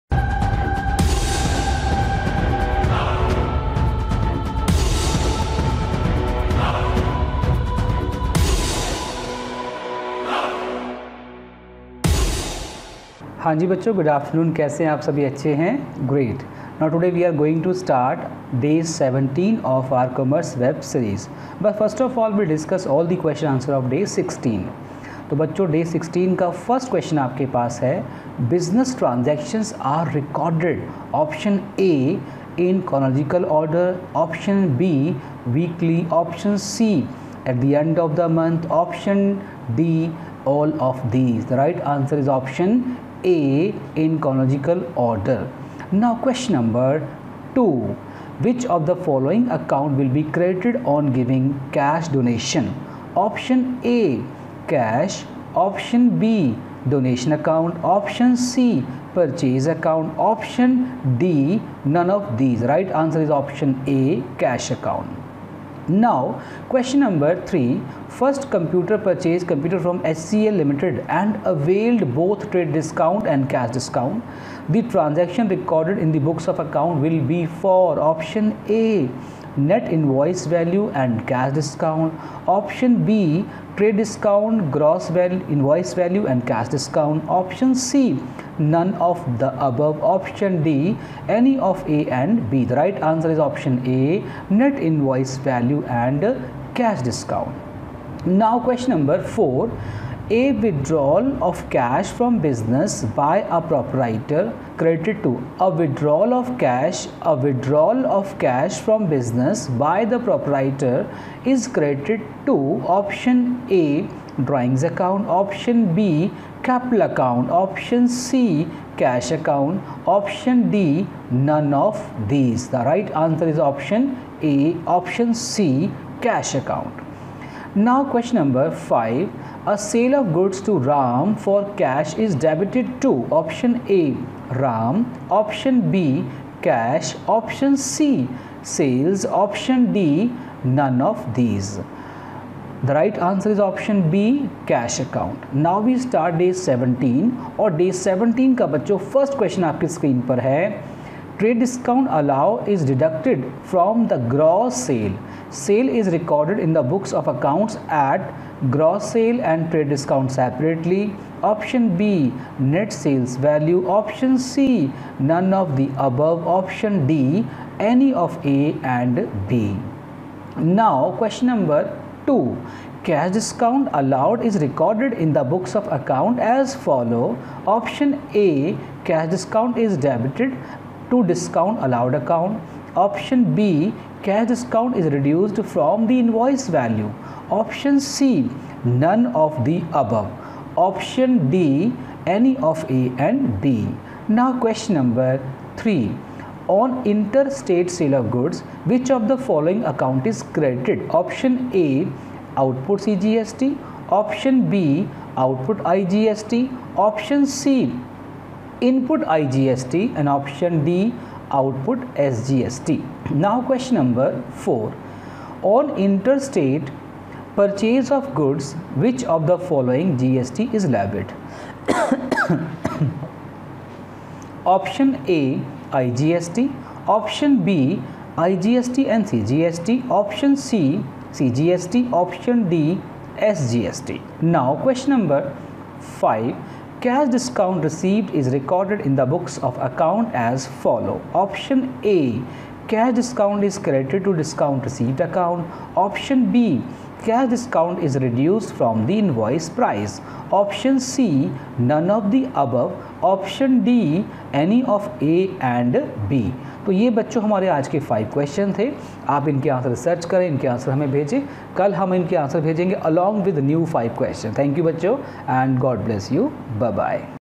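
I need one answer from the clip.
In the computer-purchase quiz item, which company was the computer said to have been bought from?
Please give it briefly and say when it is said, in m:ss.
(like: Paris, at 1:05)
HCL Limited, at 1:10.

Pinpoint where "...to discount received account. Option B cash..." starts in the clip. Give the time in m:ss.
4:04.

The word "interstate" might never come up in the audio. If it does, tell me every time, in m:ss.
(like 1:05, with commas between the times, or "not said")
3:17, 3:35.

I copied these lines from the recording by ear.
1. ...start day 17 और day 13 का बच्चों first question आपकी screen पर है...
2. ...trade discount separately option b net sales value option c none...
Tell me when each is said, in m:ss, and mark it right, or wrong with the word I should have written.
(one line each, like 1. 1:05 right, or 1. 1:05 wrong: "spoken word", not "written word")
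1. 2:25 wrong: "17", not "13"
2. 2:39 right.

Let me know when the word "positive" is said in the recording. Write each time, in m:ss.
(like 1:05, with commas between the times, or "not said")
not said.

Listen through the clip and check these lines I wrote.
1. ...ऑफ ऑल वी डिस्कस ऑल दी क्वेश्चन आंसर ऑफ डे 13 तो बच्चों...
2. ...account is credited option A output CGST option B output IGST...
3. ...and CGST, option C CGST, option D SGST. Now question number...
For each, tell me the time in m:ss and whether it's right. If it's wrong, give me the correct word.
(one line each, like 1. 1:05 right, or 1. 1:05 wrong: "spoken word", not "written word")
1. 0:22 wrong: "16", not "13"
2. 3:19 right
3. 3:49 right.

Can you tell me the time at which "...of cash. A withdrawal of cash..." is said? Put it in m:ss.
1:46.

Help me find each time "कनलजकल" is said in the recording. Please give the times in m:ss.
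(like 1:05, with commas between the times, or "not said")
0:32.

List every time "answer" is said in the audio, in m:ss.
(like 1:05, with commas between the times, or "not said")
0:41, 1:02, 1:33, 2:03, 2:23.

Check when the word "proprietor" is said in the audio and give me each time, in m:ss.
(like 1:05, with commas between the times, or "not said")
1:43, 1:50.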